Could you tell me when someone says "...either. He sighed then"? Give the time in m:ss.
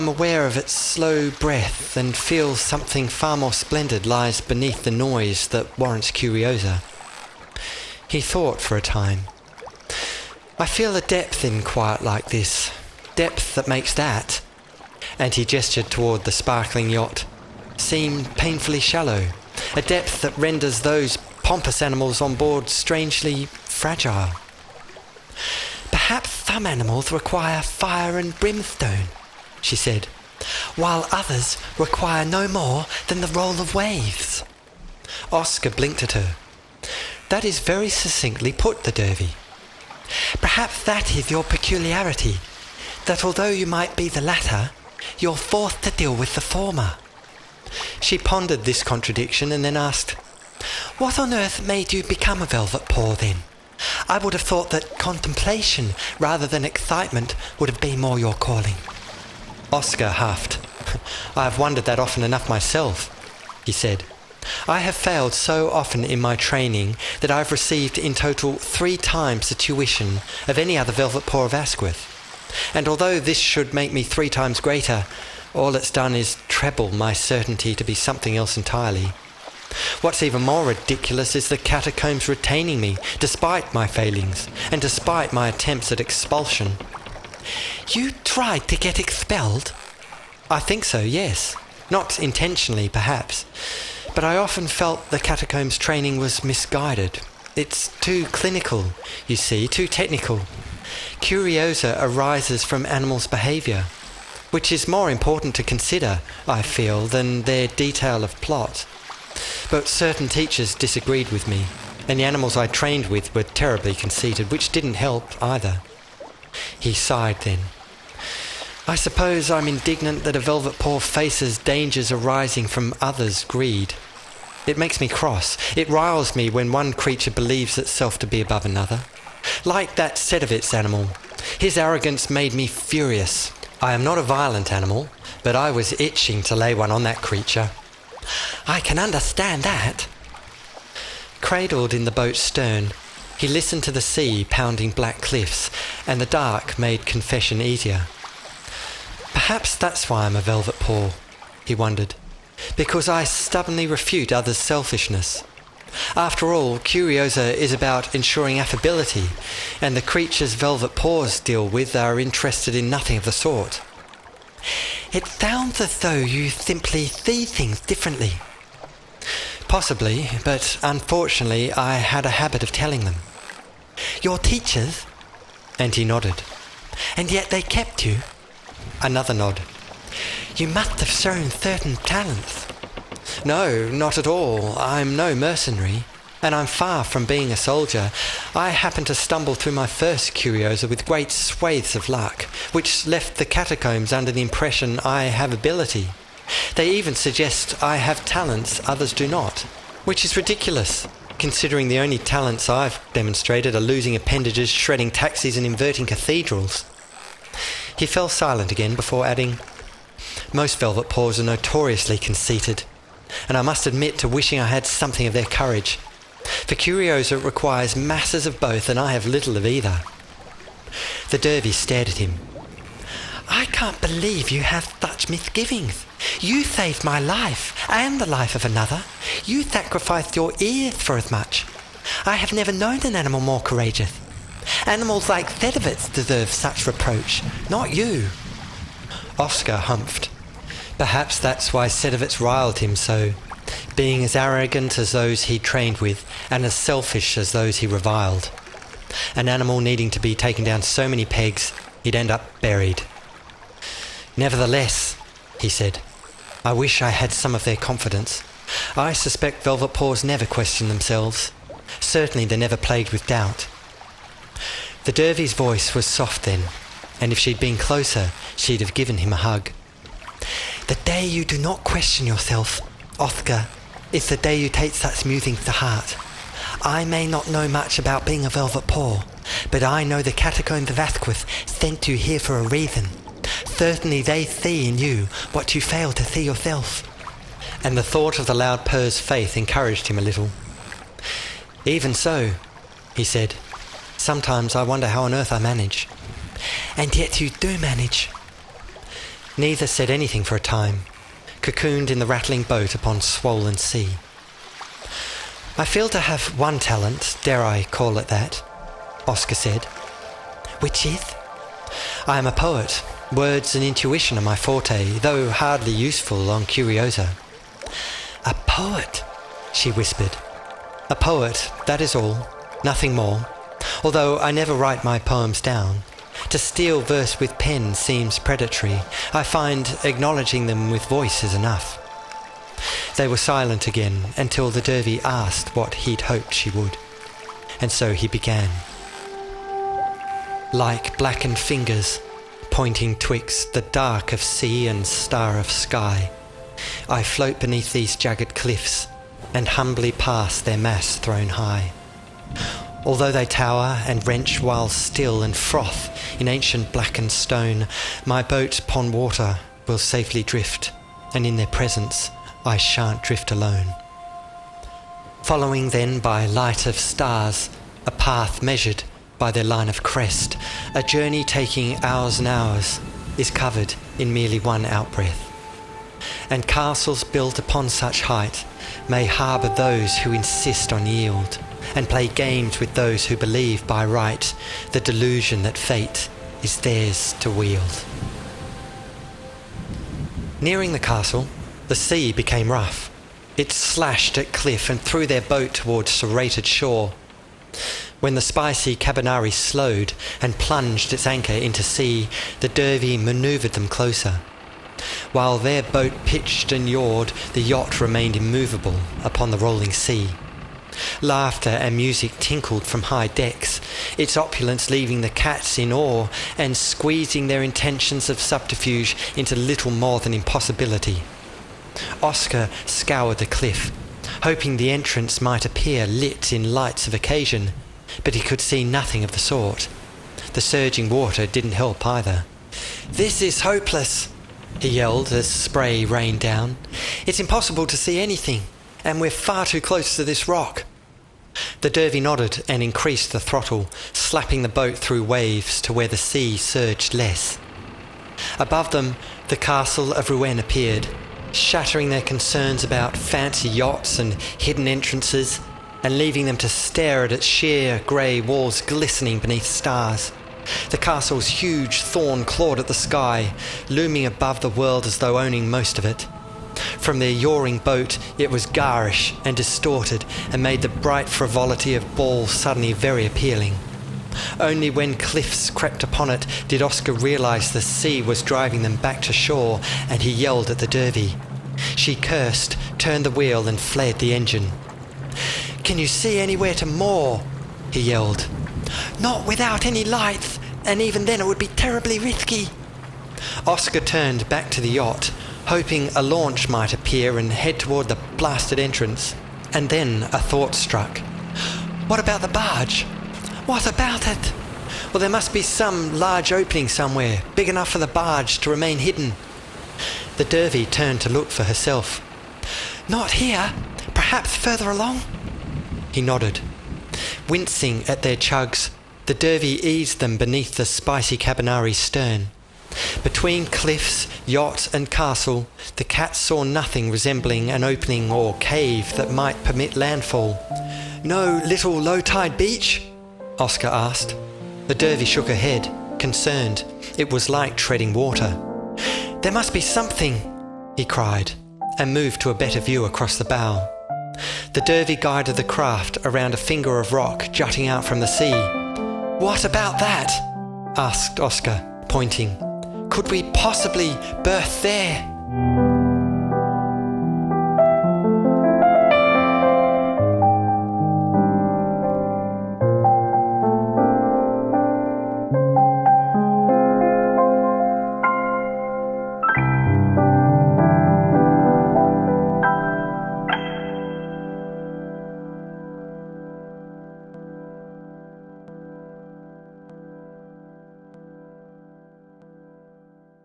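1:55.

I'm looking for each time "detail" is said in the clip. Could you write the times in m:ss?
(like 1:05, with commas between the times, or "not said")
1:47.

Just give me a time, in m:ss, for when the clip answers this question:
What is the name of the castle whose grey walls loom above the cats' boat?
7:29.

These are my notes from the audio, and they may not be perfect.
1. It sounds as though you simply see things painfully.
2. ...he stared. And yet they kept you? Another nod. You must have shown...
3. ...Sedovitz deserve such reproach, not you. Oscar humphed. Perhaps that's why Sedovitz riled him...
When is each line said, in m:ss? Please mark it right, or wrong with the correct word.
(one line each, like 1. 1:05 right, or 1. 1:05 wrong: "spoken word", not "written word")
1. 2:45 wrong: "differently", not "painfully"
2. 2:55 wrong: "nodded", not "stared"
3. 3:55 right.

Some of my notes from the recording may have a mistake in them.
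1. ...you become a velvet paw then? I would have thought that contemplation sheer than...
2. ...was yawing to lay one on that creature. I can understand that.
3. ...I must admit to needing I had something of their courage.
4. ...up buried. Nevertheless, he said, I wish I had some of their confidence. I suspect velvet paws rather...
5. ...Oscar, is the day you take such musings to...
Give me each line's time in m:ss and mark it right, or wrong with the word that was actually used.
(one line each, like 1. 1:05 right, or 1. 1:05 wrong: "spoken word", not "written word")
1. 0:51 wrong: "rather", not "sheer"
2. 2:15 wrong: "itching", not "yawing"
3. 3:33 wrong: "wishing", not "needing"
4. 4:12 wrong: "never", not "rather"
5. 4:33 right.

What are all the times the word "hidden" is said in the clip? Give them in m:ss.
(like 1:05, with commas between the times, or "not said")
7:34, 8:28.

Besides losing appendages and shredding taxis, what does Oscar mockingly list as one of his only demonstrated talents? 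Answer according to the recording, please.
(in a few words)
inverting cathedrals.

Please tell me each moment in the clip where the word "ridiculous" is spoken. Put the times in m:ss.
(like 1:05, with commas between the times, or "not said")
1:20, 3:20.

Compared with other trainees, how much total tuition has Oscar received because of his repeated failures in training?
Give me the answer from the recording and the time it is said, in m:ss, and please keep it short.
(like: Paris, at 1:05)
3 times, at 1:08.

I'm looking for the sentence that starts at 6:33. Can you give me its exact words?
It slashed at cliff and threw their boat towards serrated shore.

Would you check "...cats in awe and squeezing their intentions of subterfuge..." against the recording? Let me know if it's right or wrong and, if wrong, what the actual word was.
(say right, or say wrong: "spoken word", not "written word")
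right.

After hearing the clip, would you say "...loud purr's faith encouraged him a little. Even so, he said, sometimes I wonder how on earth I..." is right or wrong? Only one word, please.
right.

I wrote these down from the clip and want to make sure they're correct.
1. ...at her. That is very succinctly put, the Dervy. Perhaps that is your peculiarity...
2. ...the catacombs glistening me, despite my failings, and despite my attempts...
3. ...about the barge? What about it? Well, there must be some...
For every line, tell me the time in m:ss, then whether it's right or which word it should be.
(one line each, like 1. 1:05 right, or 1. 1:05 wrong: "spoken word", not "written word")
1. 0:36 right
2. 1:21 wrong: "retaining", not "glistening"
3. 8:22 right.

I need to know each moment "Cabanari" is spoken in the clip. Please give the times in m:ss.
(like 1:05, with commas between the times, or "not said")
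6:38, 8:41.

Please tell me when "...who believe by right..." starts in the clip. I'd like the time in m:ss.
6:23.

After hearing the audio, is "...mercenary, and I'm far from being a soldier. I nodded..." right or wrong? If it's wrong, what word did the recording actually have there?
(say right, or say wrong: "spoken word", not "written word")
wrong: "happened", not "nodded".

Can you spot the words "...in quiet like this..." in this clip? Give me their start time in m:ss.
0:11.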